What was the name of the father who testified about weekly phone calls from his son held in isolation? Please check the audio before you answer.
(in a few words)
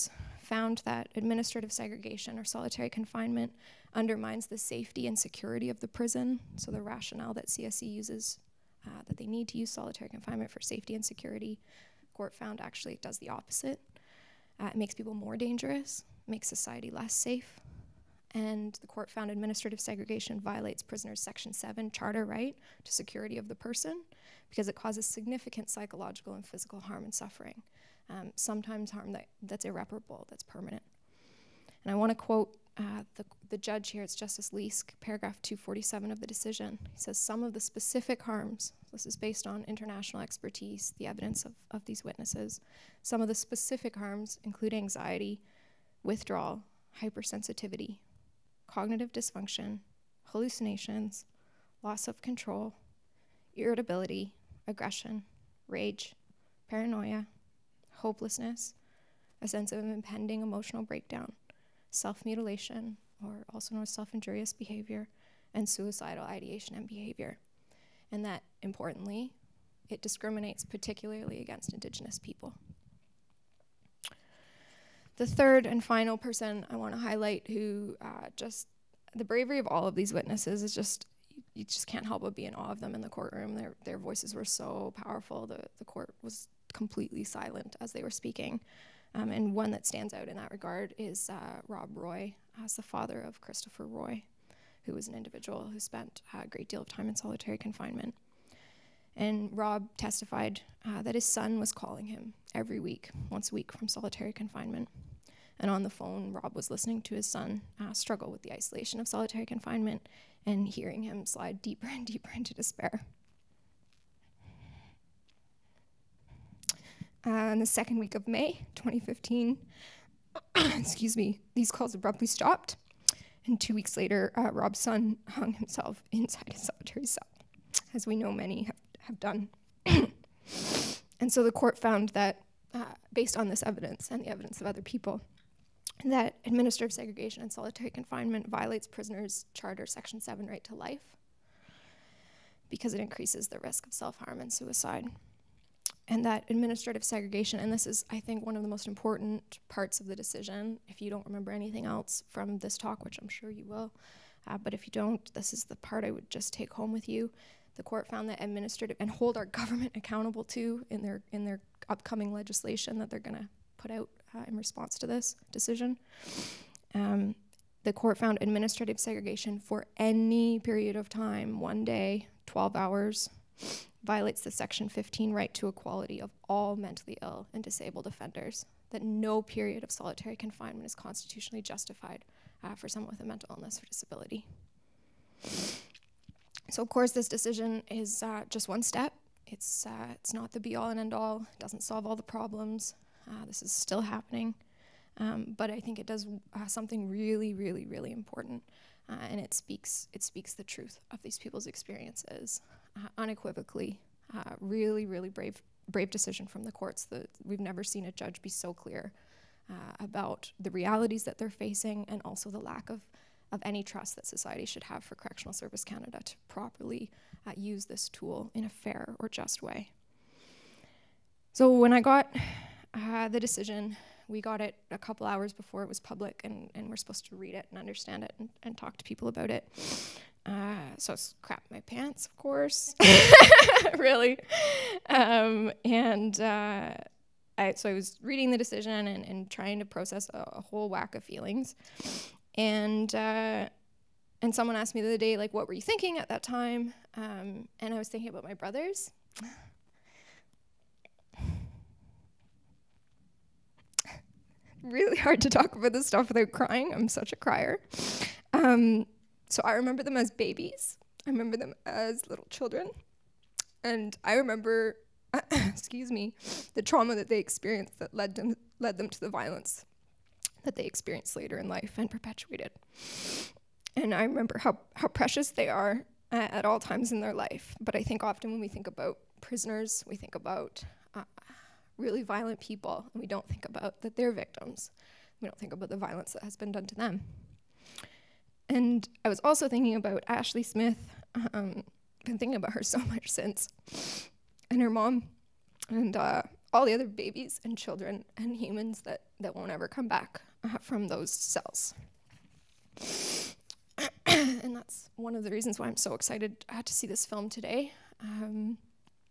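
Rob Roy.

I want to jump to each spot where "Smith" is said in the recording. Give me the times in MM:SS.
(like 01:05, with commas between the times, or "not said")
04:50.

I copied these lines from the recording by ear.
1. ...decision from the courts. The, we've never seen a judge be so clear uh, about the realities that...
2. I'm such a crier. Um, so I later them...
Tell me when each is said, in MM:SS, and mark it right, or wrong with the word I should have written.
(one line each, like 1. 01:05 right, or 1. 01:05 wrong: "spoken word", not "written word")
1. 03:26 right
2. 04:16 wrong: "remember", not "later".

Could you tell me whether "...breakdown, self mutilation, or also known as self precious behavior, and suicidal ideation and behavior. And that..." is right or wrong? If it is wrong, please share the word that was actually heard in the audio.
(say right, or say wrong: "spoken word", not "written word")
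wrong: "injurious", not "precious".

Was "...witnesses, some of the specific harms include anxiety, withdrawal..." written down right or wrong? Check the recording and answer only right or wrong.
right.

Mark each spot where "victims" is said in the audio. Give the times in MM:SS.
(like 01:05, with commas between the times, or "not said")
04:44.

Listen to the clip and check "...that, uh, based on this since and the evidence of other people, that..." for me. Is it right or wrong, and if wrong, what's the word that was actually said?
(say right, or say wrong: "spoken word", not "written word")
wrong: "evidence", not "since".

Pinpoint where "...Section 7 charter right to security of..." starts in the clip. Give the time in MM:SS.
00:21.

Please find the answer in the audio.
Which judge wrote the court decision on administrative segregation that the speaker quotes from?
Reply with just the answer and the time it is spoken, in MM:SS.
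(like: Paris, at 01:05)
Justice Leask, at 00:34.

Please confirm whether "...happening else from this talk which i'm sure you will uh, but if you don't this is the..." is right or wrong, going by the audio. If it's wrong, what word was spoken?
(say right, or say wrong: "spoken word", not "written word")
wrong: "anything", not "happening".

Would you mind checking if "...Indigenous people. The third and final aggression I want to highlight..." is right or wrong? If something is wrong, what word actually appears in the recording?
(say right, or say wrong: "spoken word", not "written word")
wrong: "person", not "aggression".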